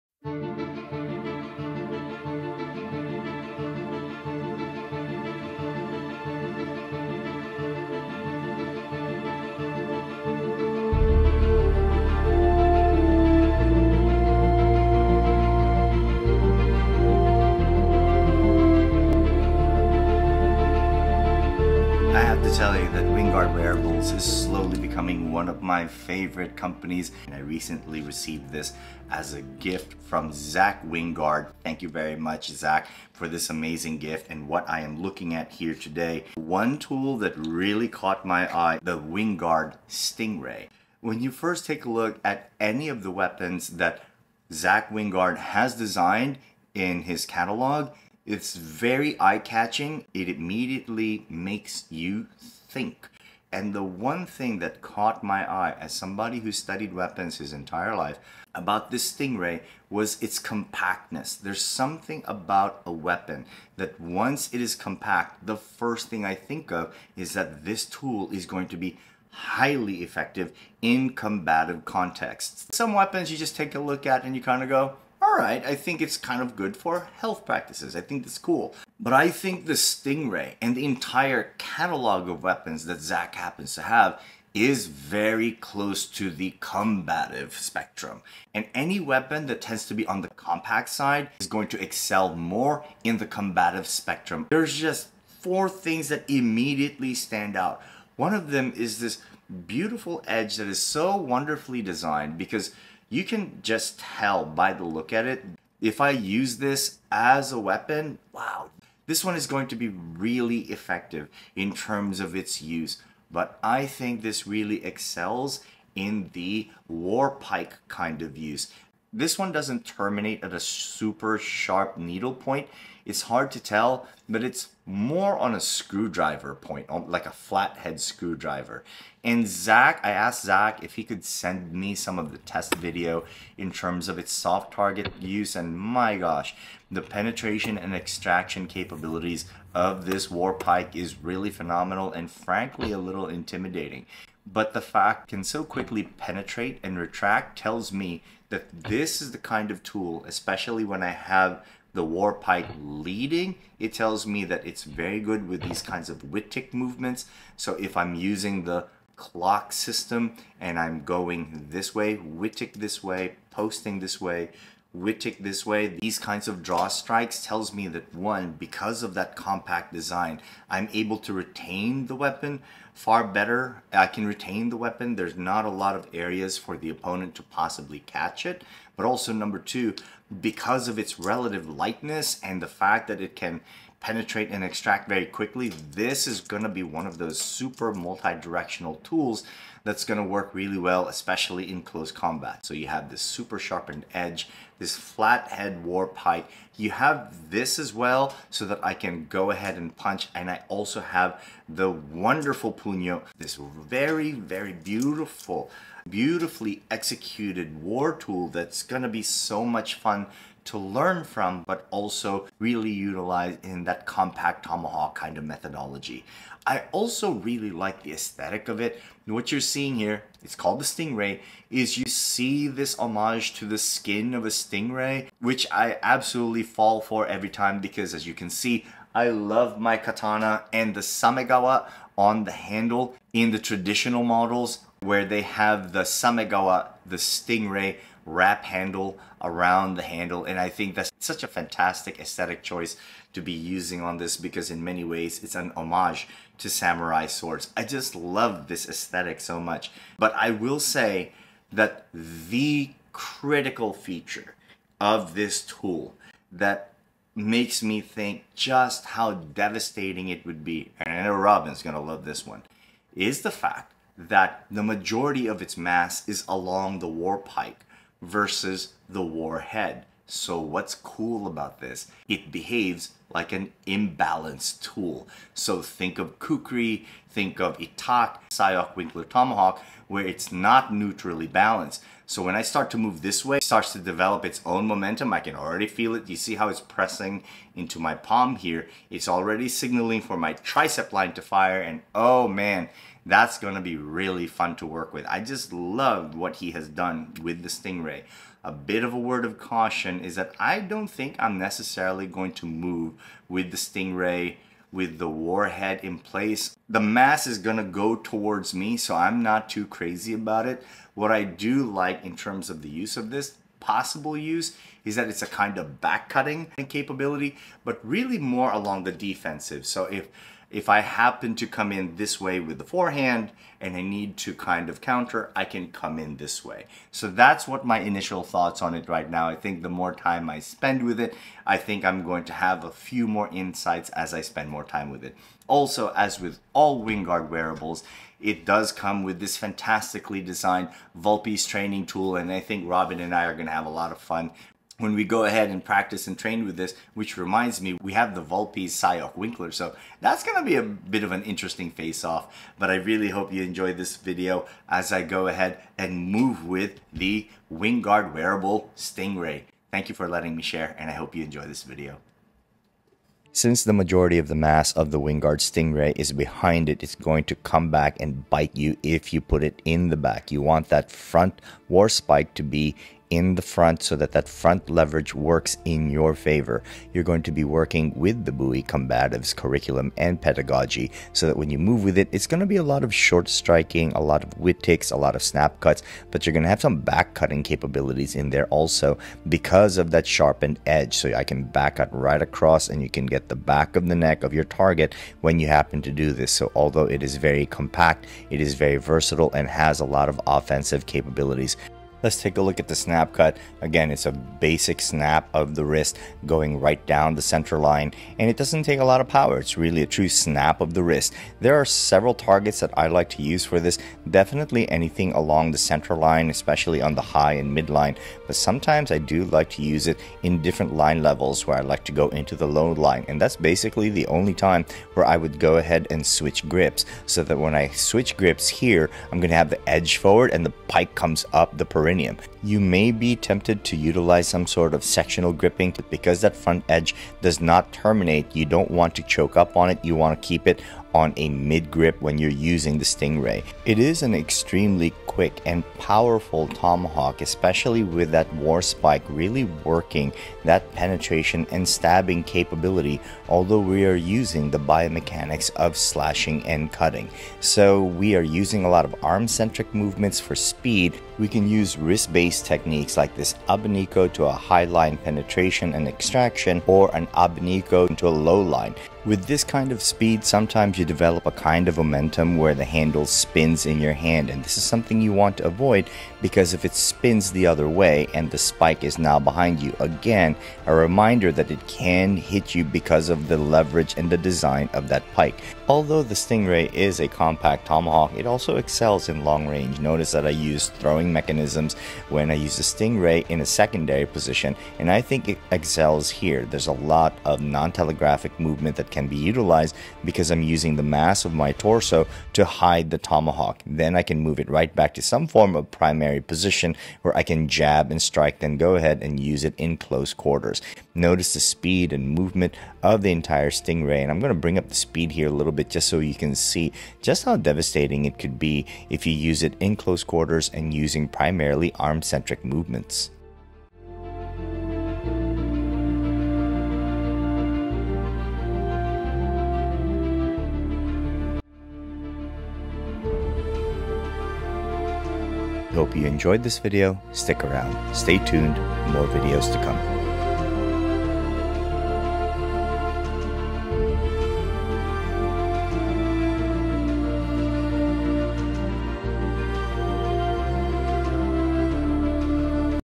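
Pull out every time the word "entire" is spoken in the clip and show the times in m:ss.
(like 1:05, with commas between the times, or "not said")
0:57, 1:20, 8:33.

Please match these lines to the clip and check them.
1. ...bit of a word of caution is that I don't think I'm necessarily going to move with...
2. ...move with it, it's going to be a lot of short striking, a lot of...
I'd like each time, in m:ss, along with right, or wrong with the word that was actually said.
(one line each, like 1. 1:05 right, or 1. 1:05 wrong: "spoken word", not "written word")
1. 4:58 right
2. 6:21 right.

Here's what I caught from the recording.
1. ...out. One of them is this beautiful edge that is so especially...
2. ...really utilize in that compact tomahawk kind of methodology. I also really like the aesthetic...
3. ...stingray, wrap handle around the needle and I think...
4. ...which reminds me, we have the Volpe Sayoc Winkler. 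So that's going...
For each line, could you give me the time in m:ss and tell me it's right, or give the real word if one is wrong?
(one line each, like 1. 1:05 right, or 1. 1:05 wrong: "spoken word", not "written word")
1. 1:37 wrong: "wonderfully", not "especially"
2. 3:32 right
3. 3:57 wrong: "handle", not "needle"
4. 5:47 right.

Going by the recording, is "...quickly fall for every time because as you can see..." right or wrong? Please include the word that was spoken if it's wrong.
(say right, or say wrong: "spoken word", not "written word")
wrong: "absolutely", not "quickly".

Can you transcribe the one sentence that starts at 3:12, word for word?
So you have this super sharpened edge, this flathead war warp height.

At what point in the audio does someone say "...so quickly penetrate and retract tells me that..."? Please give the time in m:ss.
2:25.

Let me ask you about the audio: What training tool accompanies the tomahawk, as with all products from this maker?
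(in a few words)
Vulpe's training tool.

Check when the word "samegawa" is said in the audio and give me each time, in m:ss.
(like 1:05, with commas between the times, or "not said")
3:51, 3:56.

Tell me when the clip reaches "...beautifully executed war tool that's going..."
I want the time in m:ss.
3:26.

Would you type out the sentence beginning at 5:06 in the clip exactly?
The mass is gonna go towards me, so I'm not too crazy about it.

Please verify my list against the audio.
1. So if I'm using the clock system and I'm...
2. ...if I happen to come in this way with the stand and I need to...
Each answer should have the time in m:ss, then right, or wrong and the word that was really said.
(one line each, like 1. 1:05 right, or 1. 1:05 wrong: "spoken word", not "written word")
1. 2:37 right
2. 5:20 wrong: "forehand", not "stand".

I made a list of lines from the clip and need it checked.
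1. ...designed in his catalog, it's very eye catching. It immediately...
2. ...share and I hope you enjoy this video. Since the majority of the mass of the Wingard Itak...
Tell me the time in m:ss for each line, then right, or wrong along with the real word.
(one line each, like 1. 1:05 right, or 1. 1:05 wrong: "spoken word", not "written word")
1. 0:45 right
2. 6:00 wrong: "Stingray", not "Itak".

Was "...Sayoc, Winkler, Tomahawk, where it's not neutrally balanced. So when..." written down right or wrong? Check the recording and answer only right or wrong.
right.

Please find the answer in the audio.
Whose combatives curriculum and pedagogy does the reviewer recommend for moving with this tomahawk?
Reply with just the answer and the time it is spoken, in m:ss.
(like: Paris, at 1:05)
Buoy combatives, at 6:18.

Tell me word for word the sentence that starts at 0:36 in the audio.
One tool that really caught my eye, the Wingard Stingray.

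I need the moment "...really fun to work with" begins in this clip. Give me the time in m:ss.
4:53.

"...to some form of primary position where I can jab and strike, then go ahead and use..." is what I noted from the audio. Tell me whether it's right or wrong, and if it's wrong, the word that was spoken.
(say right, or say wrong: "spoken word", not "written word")
right.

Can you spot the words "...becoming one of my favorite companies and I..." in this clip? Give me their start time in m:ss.
0:24.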